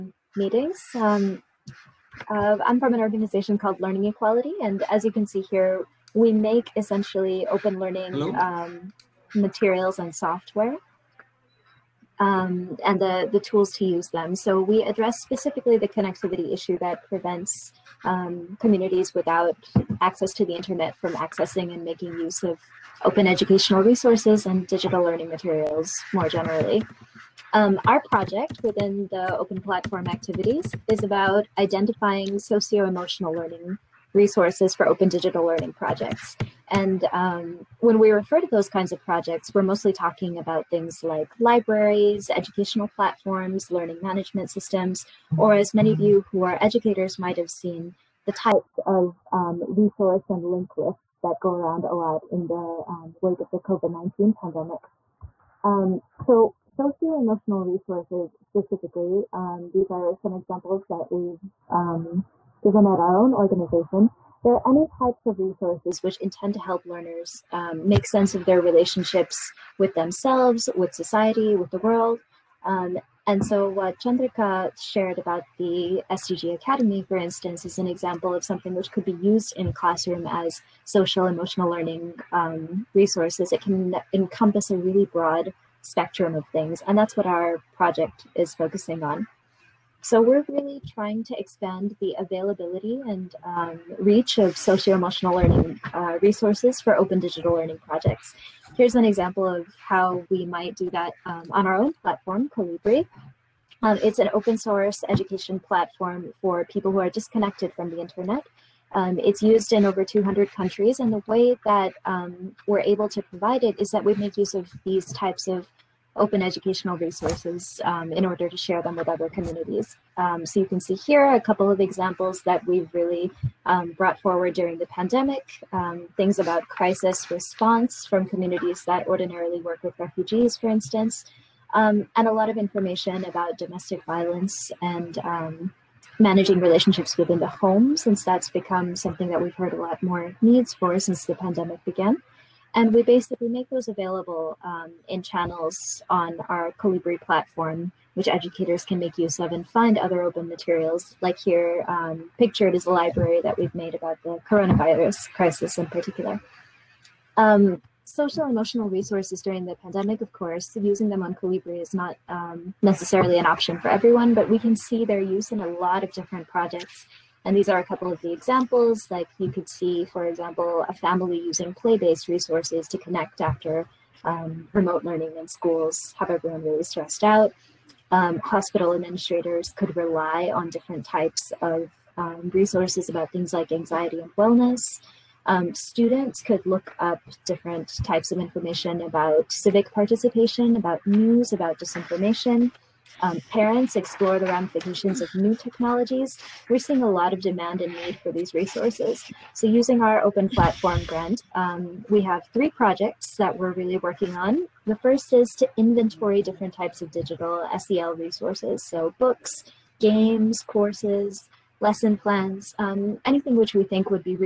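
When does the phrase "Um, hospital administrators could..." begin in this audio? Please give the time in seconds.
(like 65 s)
178 s.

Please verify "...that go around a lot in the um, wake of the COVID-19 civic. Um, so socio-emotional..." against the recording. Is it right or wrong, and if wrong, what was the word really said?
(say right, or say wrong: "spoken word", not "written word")
wrong: "pandemic", not "civic".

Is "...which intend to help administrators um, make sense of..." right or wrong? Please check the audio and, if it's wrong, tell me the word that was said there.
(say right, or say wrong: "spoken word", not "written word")
wrong: "learners", not "administrators".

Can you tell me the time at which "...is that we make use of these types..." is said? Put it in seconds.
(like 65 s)
113 s.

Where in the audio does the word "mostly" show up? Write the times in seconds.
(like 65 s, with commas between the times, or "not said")
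39 s.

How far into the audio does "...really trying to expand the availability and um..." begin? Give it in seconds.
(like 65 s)
90 s.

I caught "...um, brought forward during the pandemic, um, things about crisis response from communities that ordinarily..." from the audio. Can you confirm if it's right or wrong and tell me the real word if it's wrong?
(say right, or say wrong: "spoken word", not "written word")
right.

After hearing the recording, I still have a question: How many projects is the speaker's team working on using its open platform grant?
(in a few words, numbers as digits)
3.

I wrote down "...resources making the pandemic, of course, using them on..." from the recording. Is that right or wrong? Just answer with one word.
wrong.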